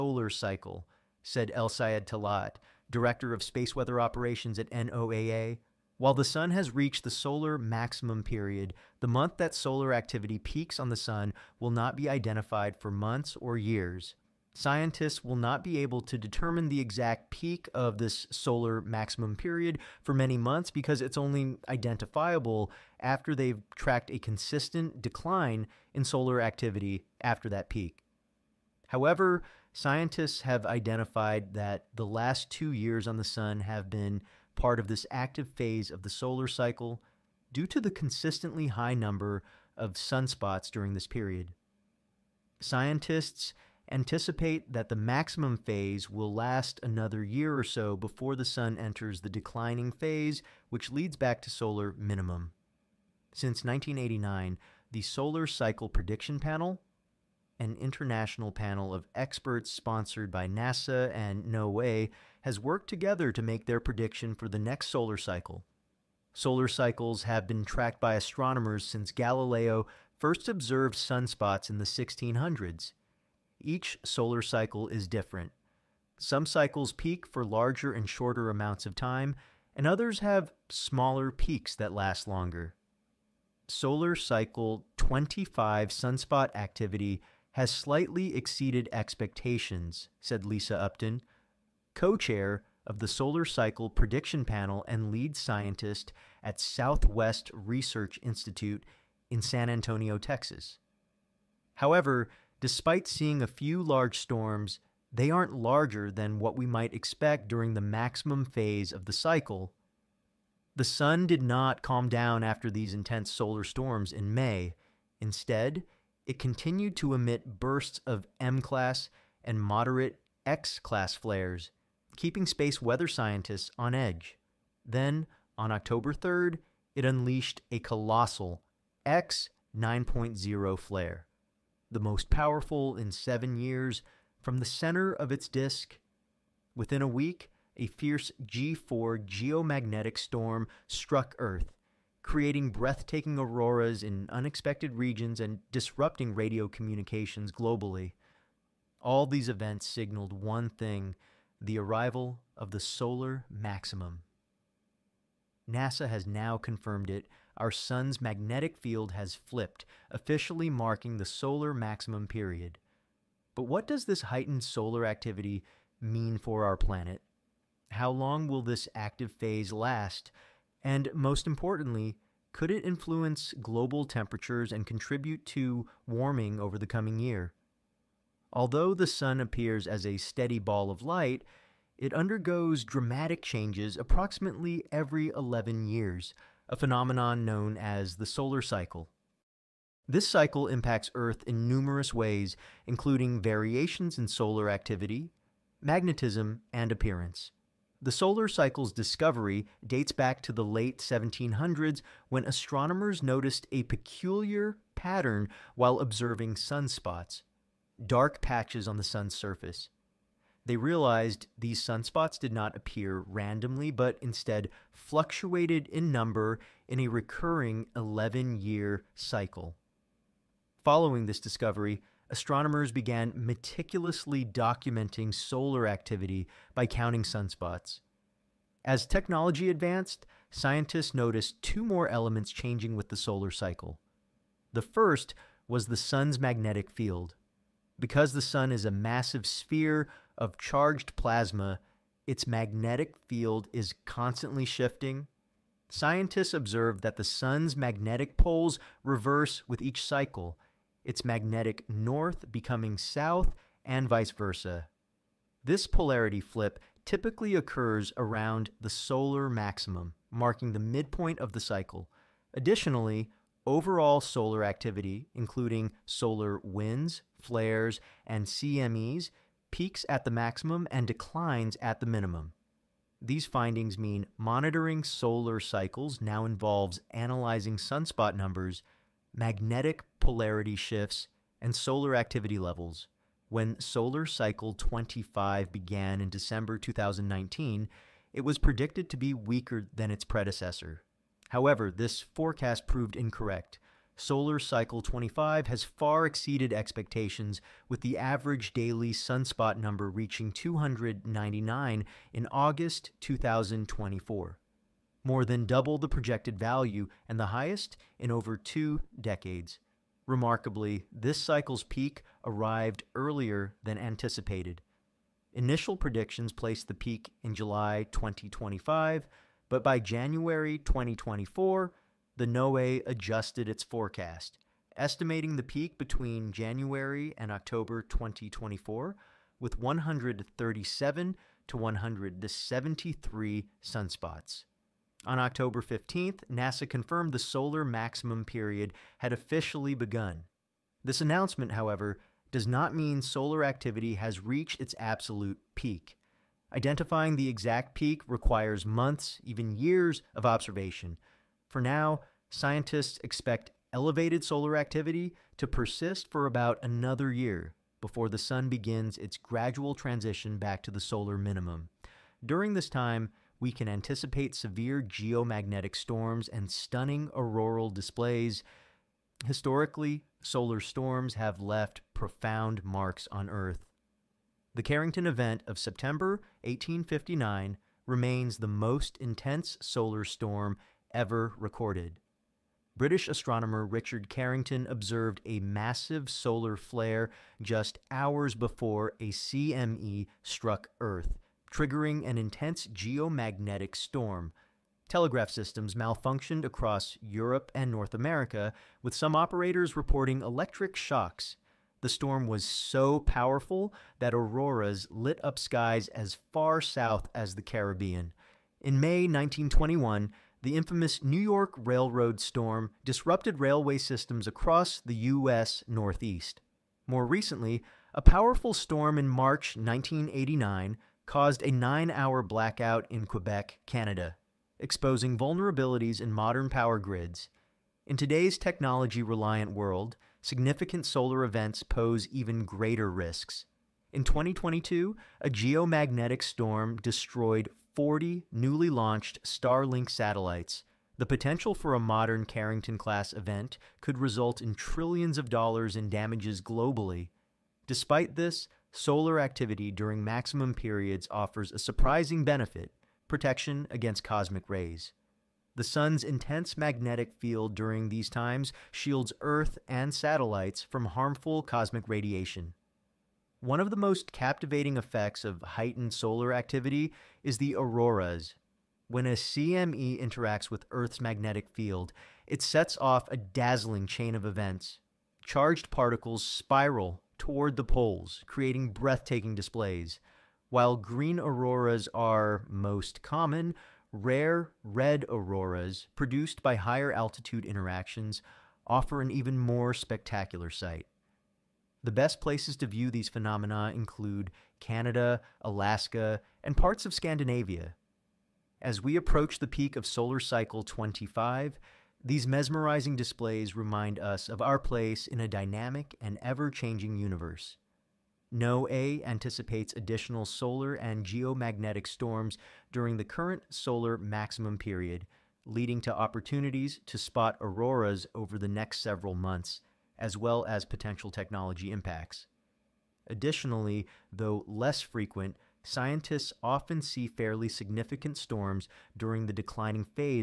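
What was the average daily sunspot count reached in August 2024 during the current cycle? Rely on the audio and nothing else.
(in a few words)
299.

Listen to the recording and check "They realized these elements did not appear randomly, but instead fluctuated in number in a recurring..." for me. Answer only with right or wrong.
wrong.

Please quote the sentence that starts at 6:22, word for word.
British astronomer Richard Carrington observed a massive solar flare just hours before a CME struck Earth, triggering an intense geomagnetic storm.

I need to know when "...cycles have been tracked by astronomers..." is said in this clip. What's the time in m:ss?
1:06.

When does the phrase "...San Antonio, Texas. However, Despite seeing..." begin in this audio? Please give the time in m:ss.
1:39.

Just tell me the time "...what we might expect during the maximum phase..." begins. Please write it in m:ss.
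1:46.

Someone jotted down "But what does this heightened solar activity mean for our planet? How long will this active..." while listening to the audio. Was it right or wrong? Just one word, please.
right.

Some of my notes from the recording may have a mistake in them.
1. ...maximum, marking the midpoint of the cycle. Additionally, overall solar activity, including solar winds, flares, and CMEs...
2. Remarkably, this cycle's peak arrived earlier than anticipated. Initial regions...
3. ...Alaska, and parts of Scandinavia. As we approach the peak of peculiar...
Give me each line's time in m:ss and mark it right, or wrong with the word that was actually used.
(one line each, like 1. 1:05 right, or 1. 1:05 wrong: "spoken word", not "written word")
1. 4:19 right
2. 5:10 wrong: "predictions", not "regions"
3. 8:15 wrong: "solar", not "peculiar".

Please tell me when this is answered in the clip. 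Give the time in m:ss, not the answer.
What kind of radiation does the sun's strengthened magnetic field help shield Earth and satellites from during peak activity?
7:41.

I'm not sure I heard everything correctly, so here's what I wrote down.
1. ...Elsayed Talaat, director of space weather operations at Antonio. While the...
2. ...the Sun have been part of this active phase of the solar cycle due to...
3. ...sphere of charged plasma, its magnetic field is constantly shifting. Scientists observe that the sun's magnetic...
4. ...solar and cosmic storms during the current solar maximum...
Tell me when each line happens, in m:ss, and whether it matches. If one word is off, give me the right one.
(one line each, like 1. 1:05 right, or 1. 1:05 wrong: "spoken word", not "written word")
1. 0:01 wrong: "NOAA", not "Antonio"
2. 0:33 right
3. 3:59 right
4. 8:30 wrong: "geomagnetic", not "cosmic".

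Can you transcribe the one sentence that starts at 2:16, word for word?
Within a week, a fierce G4 geomagnetic storm struck Earth, creating breathtaking auroras in unexpected regions and disrupting radio communications globally.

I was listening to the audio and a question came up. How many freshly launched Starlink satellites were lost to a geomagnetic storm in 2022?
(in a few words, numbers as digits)
40.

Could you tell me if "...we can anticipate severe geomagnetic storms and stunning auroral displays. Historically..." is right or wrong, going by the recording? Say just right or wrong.
right.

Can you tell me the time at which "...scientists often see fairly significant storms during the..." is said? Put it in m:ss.
8:45.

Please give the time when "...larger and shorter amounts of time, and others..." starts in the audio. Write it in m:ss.
1:17.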